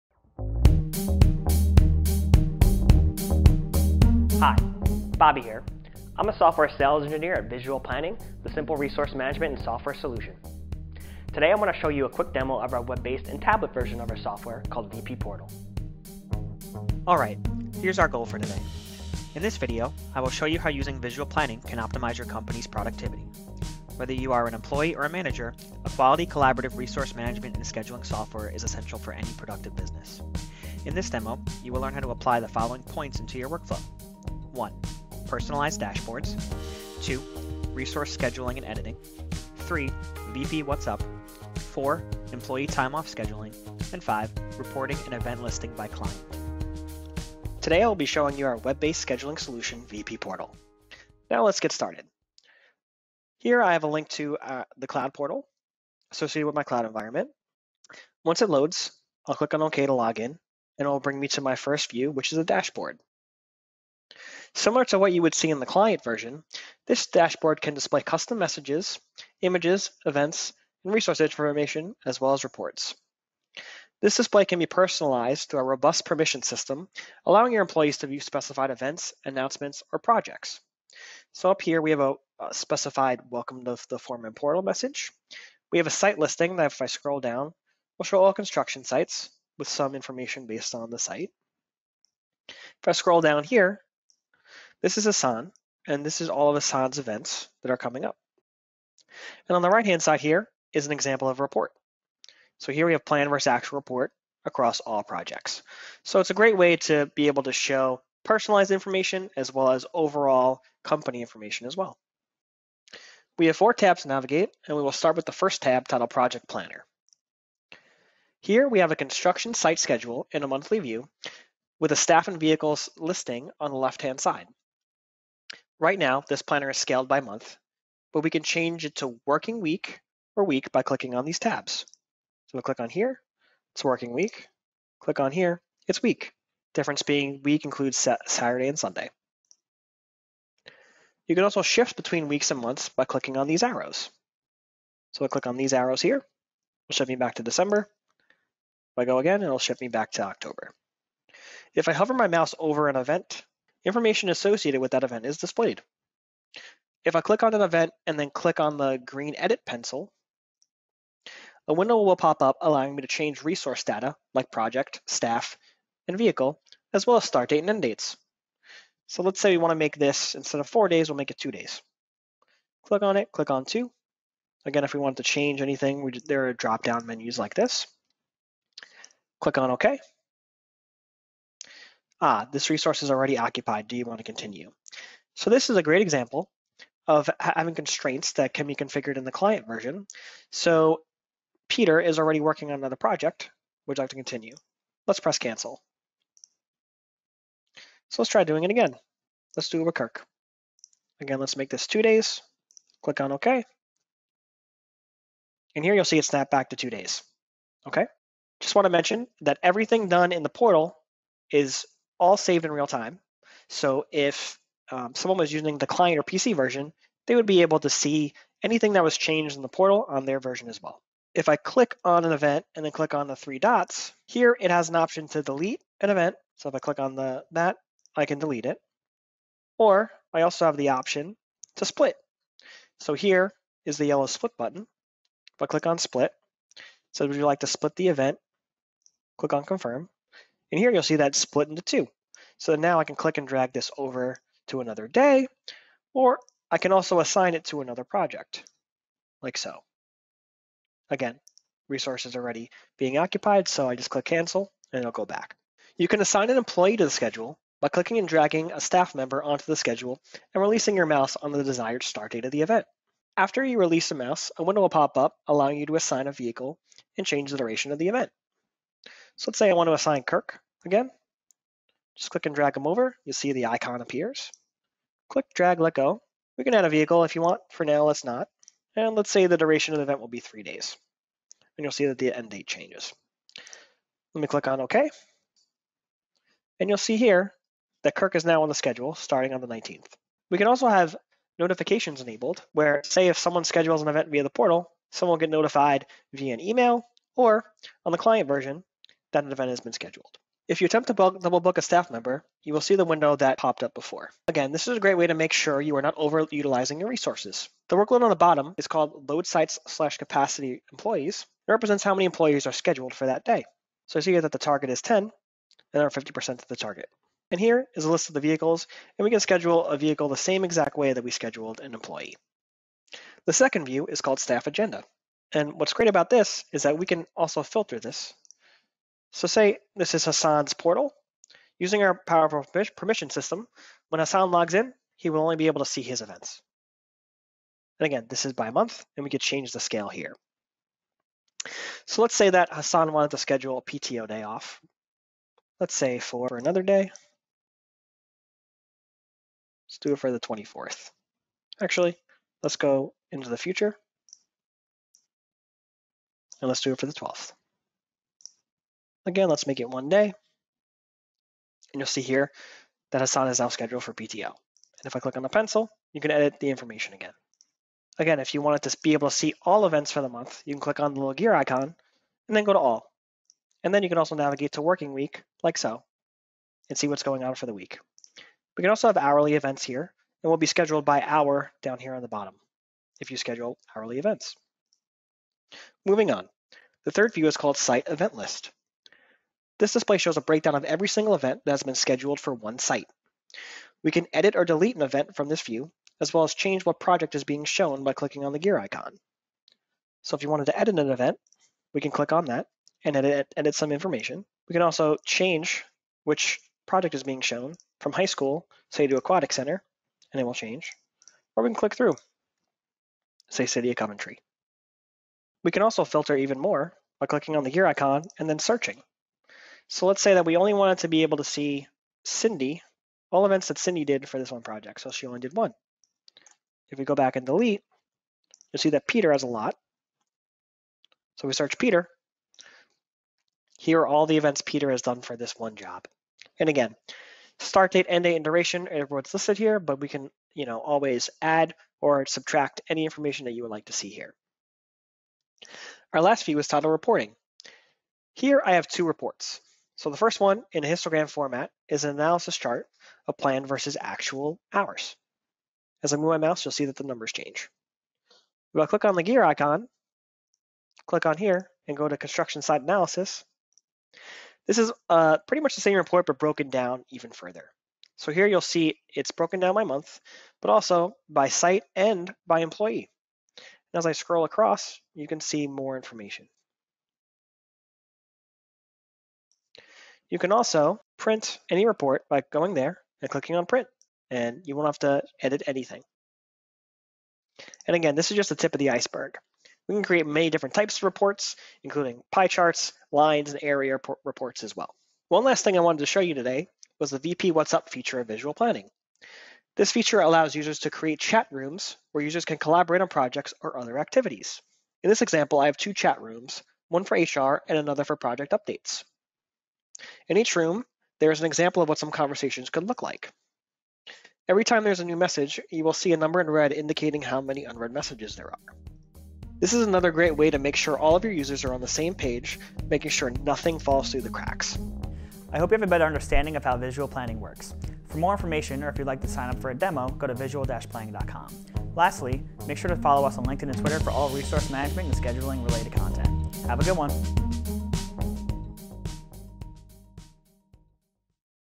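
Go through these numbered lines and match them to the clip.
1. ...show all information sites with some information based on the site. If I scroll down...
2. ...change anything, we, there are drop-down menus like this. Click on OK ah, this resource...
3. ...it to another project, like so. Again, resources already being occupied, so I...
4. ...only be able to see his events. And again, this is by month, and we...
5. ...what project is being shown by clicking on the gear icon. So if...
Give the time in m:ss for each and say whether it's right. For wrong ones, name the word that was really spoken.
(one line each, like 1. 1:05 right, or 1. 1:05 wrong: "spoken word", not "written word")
1. 1:28 wrong: "construction", not "information"
2. 2:55 right
3. 4:07 right
4. 5:35 right
5. 6:36 right.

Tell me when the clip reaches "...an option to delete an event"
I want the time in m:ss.
3:44.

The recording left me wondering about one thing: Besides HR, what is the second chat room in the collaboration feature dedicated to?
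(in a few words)
Project updates.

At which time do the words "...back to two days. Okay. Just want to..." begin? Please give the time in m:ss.
3:26.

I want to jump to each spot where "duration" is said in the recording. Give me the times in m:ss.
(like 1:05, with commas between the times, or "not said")
4:27, 4:39, 7:18.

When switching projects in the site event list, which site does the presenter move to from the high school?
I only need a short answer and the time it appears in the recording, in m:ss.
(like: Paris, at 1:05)
Aquatic center, at 6:49.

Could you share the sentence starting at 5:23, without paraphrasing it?
The second view is called staff agenda.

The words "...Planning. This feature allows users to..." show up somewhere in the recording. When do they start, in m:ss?
8:18.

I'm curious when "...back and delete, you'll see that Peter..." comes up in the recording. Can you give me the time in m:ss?
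7:07.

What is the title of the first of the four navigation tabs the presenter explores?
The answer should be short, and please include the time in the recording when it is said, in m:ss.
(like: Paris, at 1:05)
Project Planner, at 1:56.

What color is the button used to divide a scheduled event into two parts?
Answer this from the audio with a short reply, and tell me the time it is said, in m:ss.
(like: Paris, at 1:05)
Yellow, at 3:54.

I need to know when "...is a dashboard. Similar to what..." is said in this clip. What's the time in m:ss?
1:02.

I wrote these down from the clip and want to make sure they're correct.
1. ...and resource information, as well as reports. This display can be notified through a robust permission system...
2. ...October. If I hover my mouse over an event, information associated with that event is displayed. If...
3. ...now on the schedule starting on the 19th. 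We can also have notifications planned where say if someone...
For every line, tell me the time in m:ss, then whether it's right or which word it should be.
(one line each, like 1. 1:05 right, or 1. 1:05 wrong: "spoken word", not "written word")
1. 1:10 wrong: "personalized", not "notified"
2. 2:30 right
3. 4:48 wrong: "enabled", not "planned".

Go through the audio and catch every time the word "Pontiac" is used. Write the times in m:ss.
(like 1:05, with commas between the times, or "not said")
not said.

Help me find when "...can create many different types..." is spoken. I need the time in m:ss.
8:09.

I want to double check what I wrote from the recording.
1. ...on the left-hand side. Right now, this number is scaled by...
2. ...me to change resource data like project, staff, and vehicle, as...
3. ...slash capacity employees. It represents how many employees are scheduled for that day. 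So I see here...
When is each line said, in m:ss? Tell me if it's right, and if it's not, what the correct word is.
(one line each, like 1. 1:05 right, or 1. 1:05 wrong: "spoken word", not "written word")
1. 2:03 wrong: "planner", not "number"
2. 2:42 right
3. 5:09 right.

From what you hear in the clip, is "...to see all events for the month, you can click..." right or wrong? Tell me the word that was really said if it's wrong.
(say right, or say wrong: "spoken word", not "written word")
right.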